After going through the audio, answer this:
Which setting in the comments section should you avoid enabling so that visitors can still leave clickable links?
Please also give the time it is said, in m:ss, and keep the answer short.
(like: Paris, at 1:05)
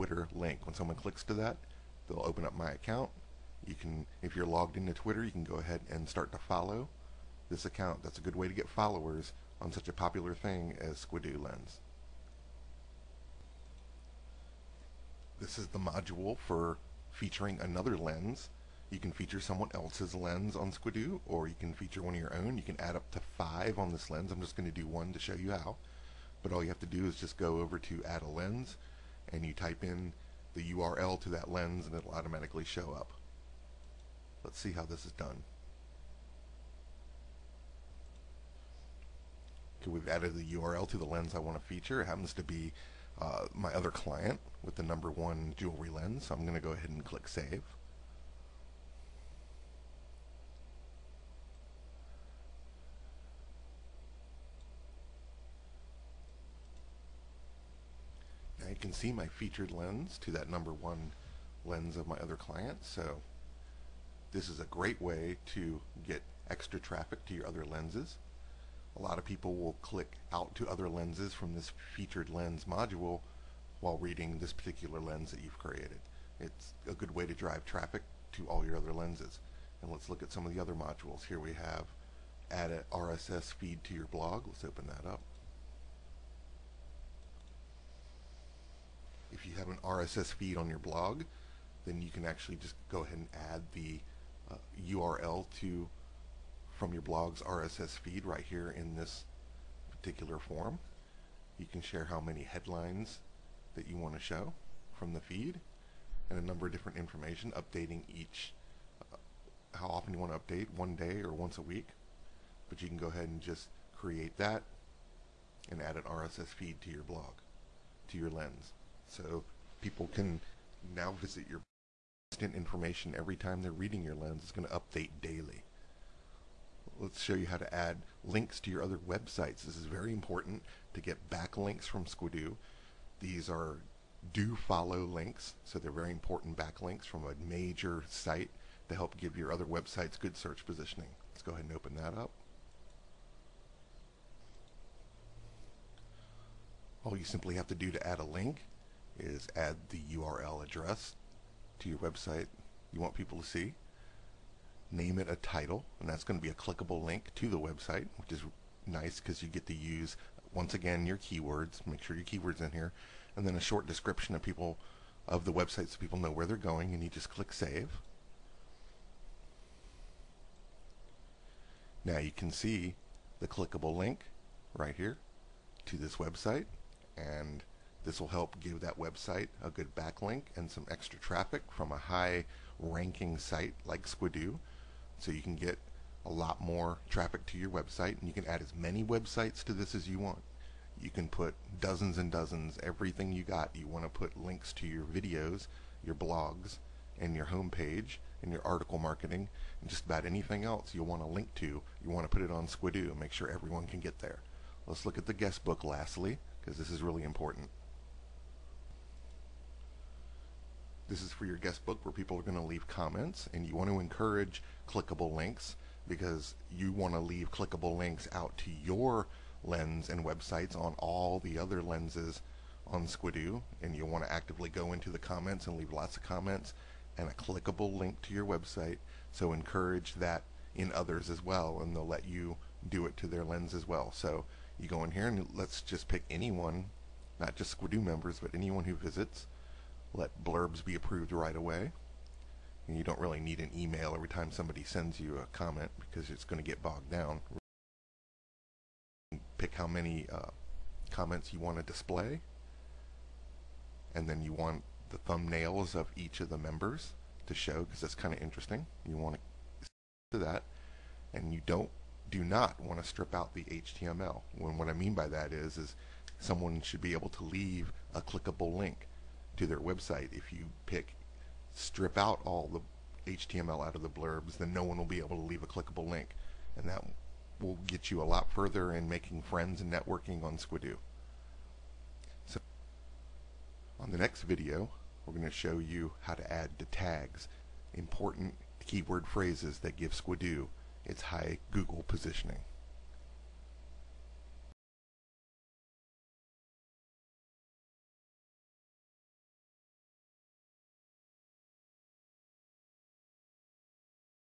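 strip out the HTML, at 4:23.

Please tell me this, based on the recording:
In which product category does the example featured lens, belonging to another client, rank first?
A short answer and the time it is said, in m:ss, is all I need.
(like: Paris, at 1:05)
jewelry, at 0:45.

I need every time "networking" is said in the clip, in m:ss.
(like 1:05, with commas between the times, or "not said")
4:39.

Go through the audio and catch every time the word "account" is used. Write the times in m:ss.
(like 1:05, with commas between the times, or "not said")
0:02, 0:07.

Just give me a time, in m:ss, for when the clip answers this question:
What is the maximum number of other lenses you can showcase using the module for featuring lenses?
0:23.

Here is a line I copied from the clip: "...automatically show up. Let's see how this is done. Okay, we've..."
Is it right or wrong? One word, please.
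right.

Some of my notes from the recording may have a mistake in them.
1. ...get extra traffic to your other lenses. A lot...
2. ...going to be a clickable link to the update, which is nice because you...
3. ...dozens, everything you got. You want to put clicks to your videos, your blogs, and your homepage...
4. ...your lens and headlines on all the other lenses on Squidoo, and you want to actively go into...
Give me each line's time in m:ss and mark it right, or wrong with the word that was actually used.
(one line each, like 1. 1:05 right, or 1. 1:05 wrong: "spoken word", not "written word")
1. 1:06 right
2. 2:36 wrong: "website", not "update"
3. 3:12 wrong: "links", not "clicks"
4. 3:38 wrong: "websites", not "headlines".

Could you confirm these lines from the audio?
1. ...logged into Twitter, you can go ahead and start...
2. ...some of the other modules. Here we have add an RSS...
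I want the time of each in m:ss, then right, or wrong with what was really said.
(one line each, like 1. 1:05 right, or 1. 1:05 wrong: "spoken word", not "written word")
1. 0:04 right
2. 1:20 right.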